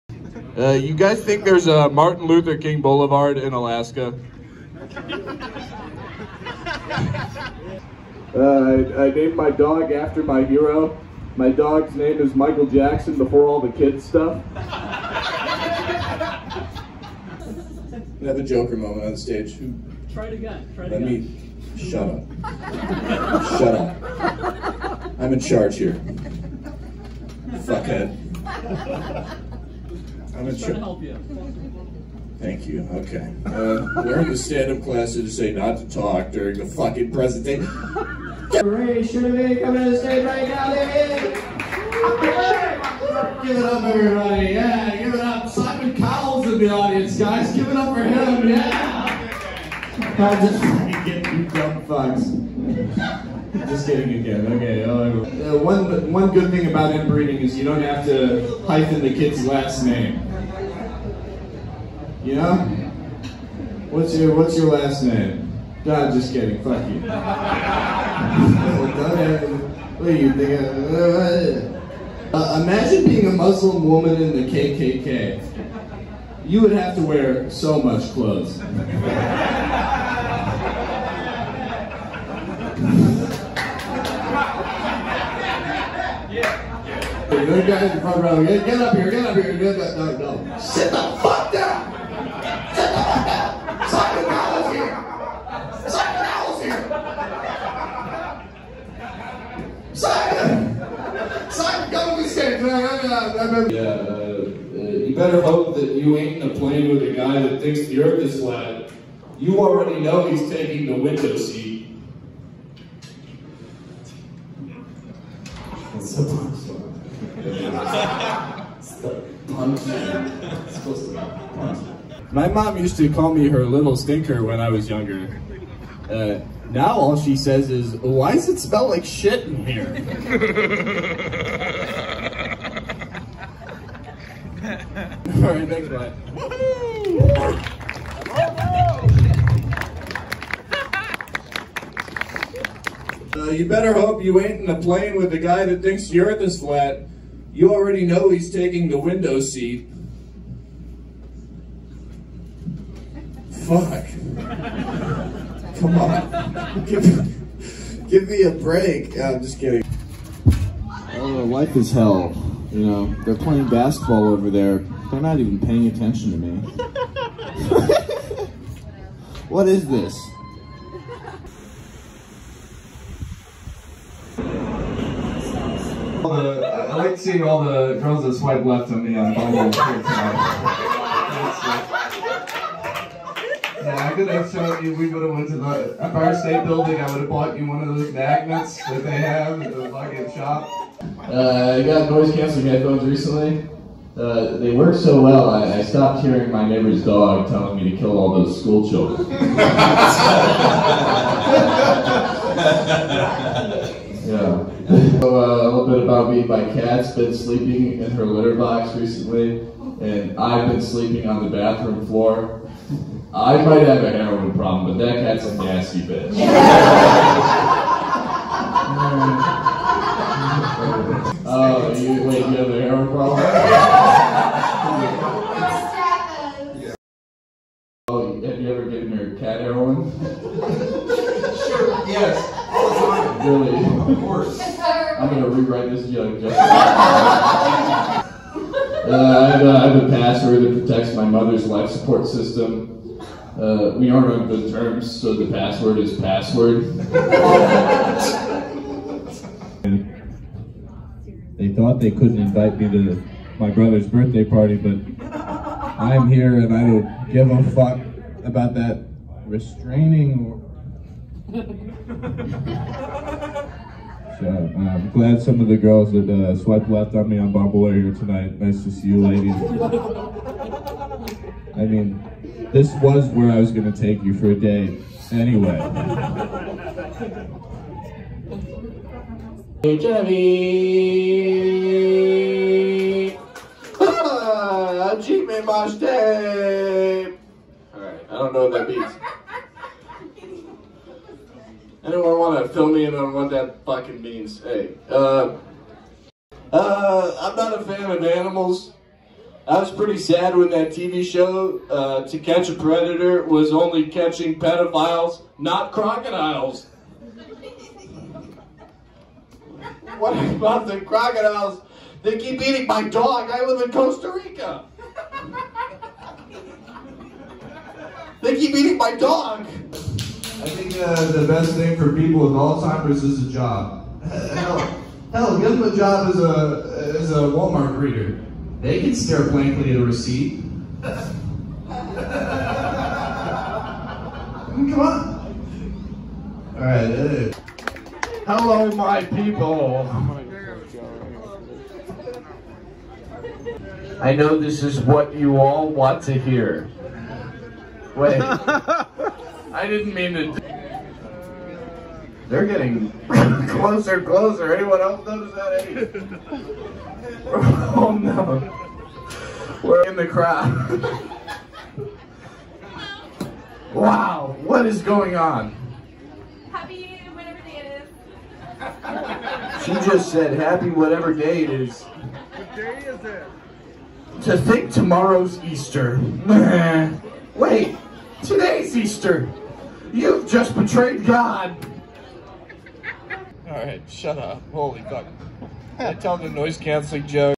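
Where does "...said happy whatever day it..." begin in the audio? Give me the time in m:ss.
6:10.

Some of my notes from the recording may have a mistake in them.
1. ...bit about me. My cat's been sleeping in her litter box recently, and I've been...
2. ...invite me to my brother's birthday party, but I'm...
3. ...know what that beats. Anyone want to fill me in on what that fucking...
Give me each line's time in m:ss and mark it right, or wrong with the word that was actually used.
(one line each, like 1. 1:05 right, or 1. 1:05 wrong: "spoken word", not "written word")
1. 3:25 right
2. 4:12 right
3. 4:48 right.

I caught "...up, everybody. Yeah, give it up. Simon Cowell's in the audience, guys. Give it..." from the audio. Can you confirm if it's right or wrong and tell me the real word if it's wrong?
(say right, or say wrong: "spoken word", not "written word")
right.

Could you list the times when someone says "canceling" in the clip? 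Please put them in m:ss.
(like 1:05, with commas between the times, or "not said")
3:12, 6:26.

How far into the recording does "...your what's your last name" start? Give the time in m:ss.
1:04.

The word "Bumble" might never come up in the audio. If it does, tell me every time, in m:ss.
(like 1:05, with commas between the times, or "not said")
2:59, 4:27.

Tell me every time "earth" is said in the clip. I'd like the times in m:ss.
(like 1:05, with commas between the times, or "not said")
1:48, 2:26.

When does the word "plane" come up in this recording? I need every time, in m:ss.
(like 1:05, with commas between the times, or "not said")
1:46, 2:24.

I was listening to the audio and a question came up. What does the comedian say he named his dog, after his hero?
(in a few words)
Michael Jackson.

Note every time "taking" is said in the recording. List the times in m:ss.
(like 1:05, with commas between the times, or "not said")
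1:50, 2:28.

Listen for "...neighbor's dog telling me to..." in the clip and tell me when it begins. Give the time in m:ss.
3:16.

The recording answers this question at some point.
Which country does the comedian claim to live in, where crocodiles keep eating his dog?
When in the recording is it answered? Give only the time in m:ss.
5:13.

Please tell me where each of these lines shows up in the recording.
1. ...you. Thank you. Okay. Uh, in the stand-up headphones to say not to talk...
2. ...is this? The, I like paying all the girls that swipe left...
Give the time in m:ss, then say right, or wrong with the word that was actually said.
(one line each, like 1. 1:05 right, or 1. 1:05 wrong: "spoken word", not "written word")
1. 0:31 wrong: "classes", not "headphones"
2. 2:49 wrong: "seeing", not "paying".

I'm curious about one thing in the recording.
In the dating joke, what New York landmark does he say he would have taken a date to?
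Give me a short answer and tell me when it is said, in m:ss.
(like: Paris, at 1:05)
Empire State Building, at 3:05.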